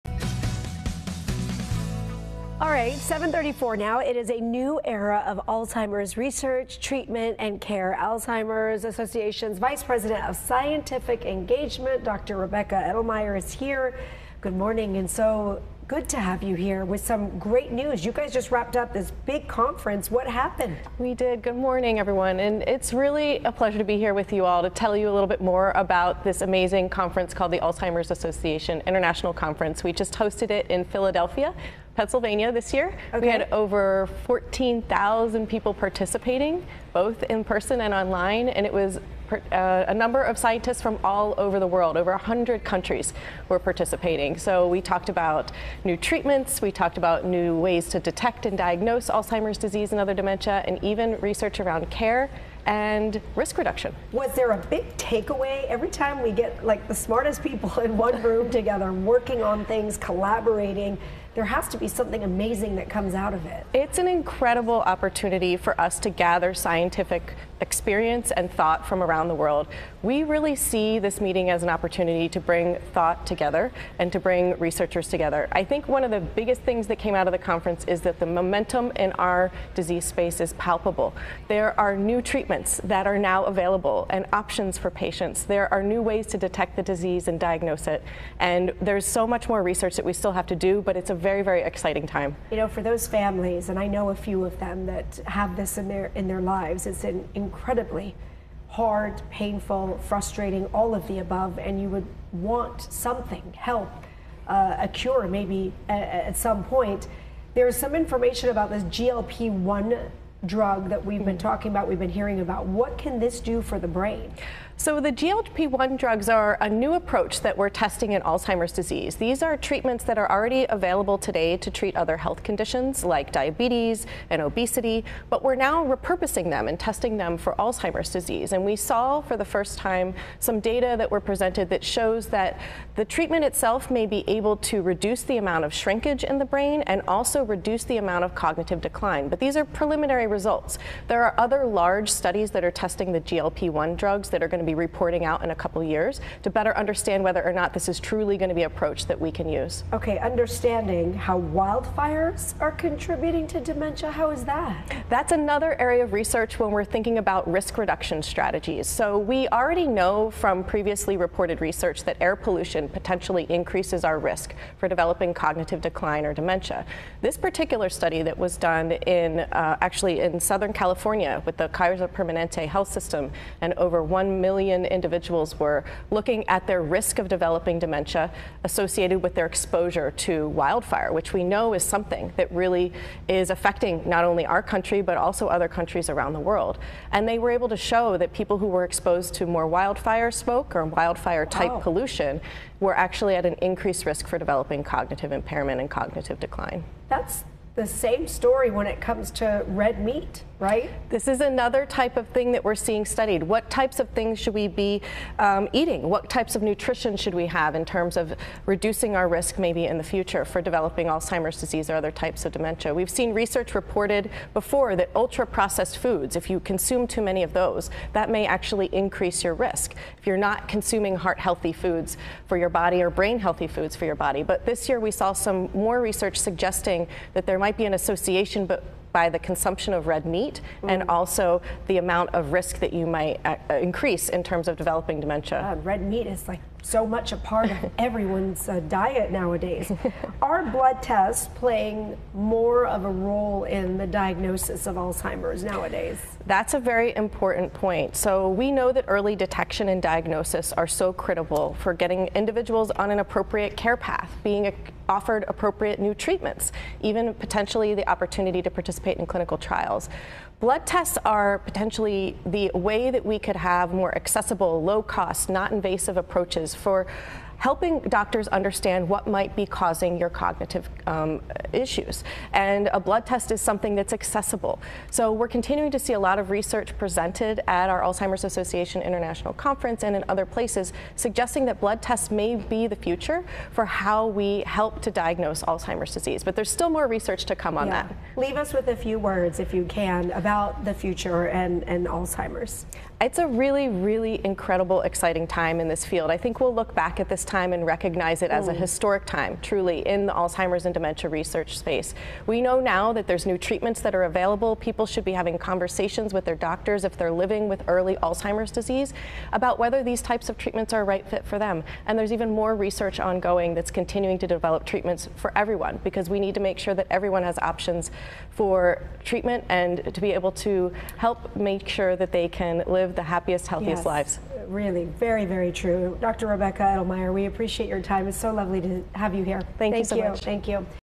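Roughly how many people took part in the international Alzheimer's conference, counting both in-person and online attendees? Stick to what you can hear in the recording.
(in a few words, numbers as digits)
14,000.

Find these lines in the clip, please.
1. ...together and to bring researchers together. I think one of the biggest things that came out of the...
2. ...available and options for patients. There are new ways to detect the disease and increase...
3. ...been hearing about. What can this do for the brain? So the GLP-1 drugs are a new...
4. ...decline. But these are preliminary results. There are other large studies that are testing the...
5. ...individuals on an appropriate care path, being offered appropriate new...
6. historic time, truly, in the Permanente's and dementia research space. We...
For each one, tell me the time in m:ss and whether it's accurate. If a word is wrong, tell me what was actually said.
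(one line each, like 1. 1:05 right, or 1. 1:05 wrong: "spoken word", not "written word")
1. 1:13 right
2. 1:23 wrong: "diagnose", not "increase"
3. 1:51 right
4. 2:18 right
5. 4:12 right
6. 4:58 wrong: "Alzheimer", not "Permanente".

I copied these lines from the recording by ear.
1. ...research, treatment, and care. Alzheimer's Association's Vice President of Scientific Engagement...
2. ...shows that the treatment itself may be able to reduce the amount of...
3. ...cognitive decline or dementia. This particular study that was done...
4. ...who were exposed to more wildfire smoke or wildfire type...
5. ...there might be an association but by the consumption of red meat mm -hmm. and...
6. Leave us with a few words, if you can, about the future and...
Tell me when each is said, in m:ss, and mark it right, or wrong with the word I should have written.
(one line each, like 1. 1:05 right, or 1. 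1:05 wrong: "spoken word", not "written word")
1. 0:06 right
2. 2:11 right
3. 2:45 right
4. 3:08 right
5. 3:47 right
6. 4:48 right.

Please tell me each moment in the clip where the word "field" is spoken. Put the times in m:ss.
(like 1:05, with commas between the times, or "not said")
4:56.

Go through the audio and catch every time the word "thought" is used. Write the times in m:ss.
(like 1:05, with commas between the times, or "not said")
1:08, 1:12.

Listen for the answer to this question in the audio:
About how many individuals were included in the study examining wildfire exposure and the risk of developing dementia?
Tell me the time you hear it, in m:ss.
2:54.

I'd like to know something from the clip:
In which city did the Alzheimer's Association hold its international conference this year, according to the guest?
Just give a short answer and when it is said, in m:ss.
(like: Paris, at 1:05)
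Philadelphia, at 0:30.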